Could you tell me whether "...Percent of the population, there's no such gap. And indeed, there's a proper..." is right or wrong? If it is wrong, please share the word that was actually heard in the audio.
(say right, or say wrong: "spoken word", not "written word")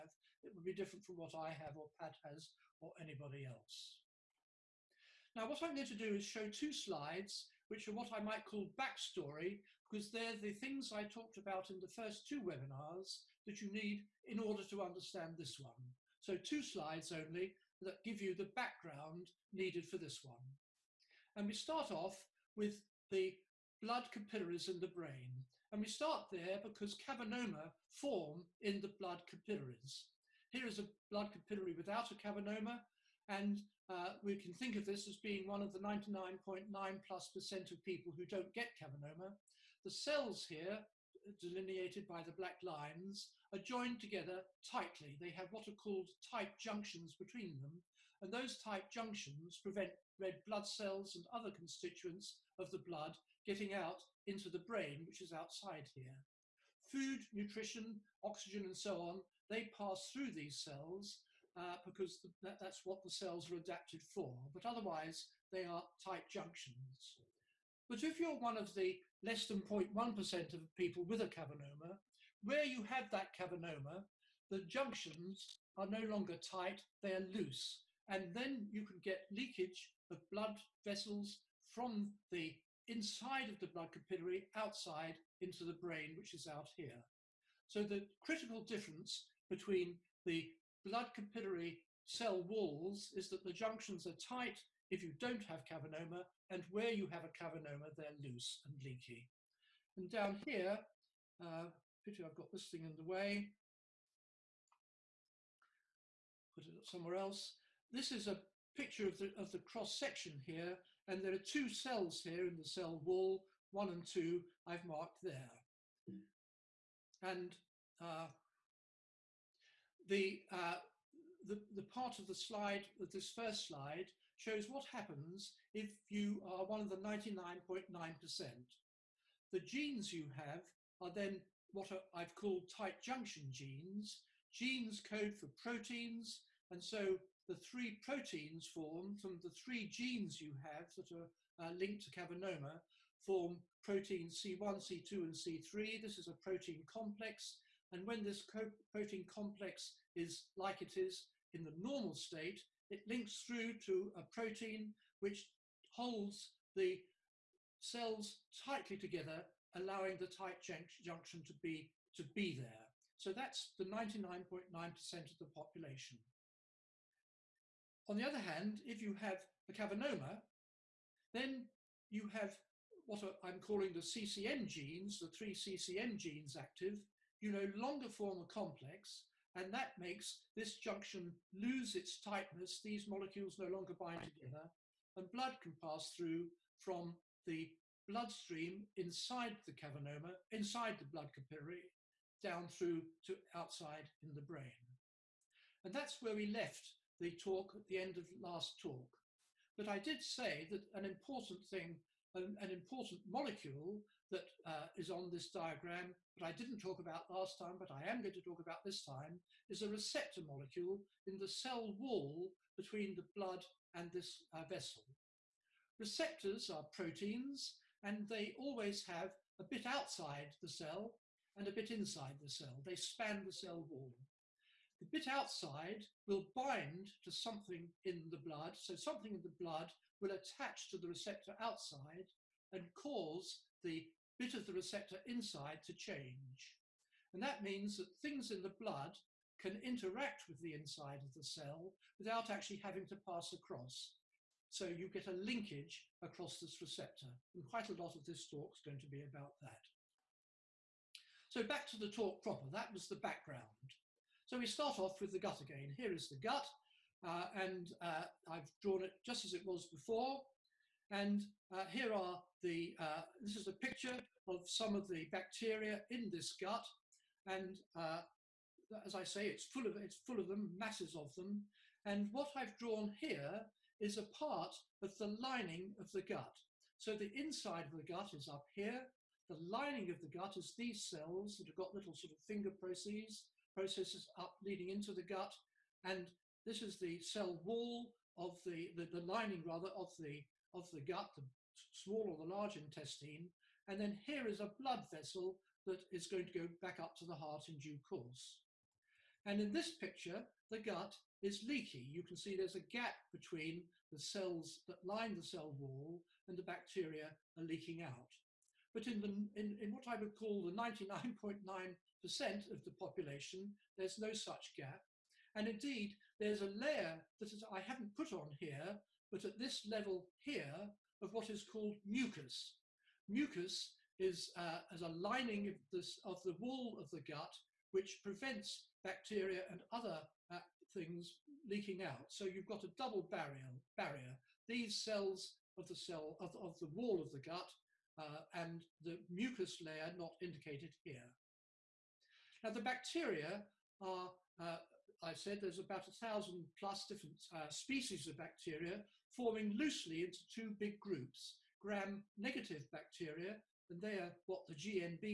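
wrong: "layer", not "proper".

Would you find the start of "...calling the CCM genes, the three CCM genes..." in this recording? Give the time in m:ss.
2:53.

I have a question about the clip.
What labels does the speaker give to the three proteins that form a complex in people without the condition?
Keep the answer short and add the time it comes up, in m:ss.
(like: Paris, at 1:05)
C1, C2, and C3, at 2:24.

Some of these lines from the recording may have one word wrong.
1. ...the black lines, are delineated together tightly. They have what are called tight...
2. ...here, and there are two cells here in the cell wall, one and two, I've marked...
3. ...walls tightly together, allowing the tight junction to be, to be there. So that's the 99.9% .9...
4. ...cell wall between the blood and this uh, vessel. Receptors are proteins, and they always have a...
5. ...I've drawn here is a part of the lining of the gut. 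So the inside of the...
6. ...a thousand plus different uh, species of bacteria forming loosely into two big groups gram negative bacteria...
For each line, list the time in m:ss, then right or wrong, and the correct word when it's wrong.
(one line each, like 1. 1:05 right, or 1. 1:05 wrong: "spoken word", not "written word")
1. 0:42 wrong: "joined", not "delineated"
2. 1:50 right
3. 2:37 wrong: "cells", not "walls"
4. 3:31 right
5. 4:32 right
6. 5:46 right.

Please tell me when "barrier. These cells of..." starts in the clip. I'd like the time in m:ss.
5:33.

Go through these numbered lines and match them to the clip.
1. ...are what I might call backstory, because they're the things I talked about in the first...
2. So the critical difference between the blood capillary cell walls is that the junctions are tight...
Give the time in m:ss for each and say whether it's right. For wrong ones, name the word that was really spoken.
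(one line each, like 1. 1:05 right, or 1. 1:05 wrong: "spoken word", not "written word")
1. 0:07 right
2. 1:27 right.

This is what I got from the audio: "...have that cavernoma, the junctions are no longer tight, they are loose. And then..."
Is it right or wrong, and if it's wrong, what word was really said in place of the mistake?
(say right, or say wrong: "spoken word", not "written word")
right.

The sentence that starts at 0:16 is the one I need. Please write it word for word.
So two slides only that give you the background needed for this one.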